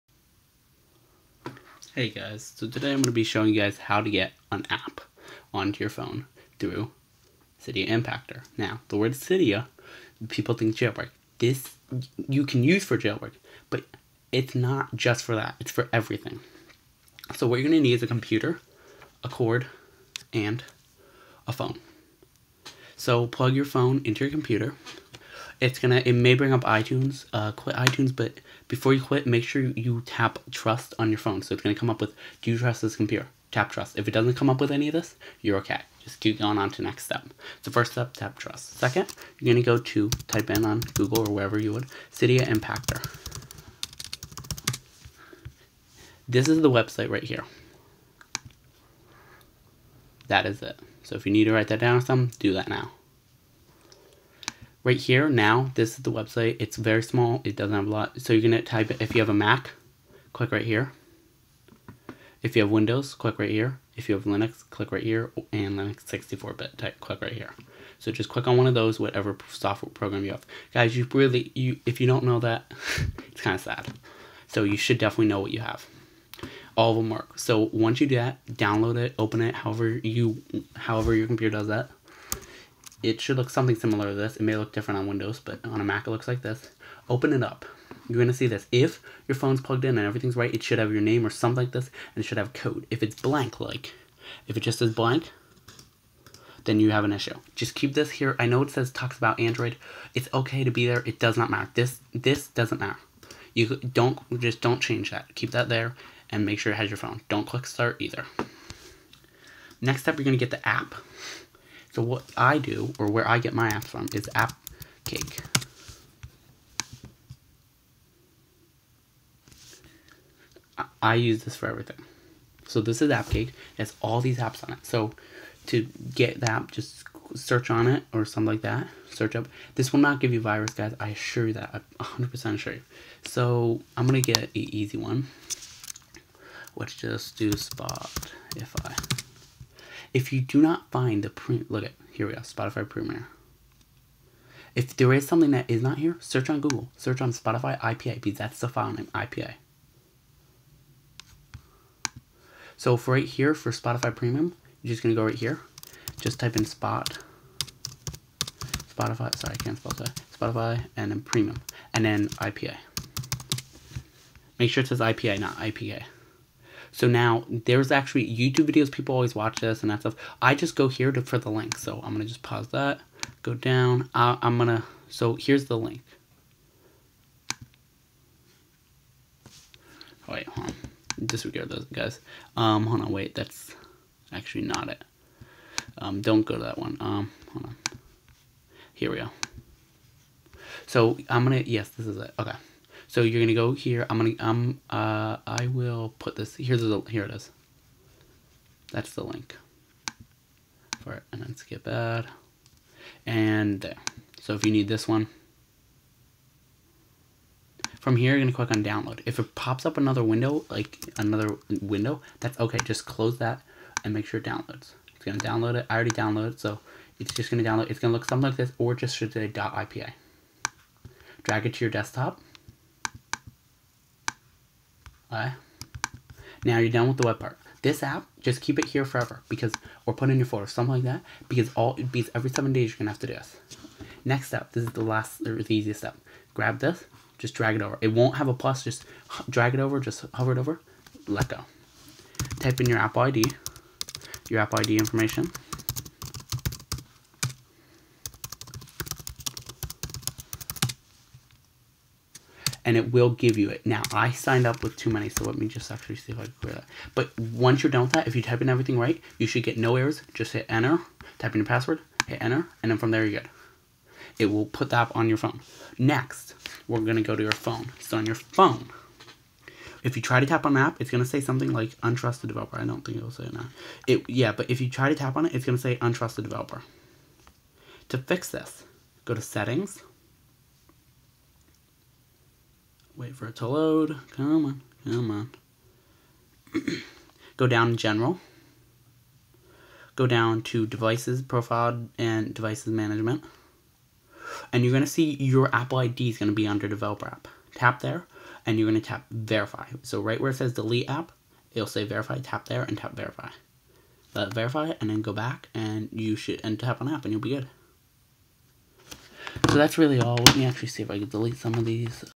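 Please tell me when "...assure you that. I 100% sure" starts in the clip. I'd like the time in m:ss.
2:11.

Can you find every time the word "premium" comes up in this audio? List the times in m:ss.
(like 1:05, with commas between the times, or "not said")
2:22, 2:34, 2:41.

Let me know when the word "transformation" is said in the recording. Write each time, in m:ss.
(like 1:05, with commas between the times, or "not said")
not said.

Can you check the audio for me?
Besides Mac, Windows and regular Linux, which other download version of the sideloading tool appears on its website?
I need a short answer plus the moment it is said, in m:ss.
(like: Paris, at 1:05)
Linux 64-bit, at 1:05.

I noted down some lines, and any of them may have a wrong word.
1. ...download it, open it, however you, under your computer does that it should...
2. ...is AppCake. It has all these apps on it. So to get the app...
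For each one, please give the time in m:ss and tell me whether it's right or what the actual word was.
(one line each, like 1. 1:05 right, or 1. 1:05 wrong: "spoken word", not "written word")
1. 1:18 wrong: "however", not "under"
2. 2:03 right.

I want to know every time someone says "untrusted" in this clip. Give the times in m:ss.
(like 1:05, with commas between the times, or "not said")
4:32, 4:36.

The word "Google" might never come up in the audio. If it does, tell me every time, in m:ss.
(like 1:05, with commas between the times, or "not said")
0:40, 2:26.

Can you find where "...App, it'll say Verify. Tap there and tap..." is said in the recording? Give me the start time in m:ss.
5:01.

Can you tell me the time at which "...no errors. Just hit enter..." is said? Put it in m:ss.
4:19.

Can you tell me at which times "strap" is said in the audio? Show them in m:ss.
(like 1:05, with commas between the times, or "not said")
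not said.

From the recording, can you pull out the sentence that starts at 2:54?
I, I'm going to, so here's the link.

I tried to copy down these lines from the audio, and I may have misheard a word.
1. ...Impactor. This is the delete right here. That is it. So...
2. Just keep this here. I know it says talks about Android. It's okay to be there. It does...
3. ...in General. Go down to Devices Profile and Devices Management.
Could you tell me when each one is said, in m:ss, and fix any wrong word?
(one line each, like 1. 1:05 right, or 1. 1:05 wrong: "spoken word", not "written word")
1. 0:42 wrong: "website", not "delete"
2. 1:37 right
3. 4:47 right.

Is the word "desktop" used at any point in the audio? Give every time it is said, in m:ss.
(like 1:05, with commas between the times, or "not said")
3:41.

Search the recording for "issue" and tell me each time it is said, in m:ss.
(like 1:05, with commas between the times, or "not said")
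1:37.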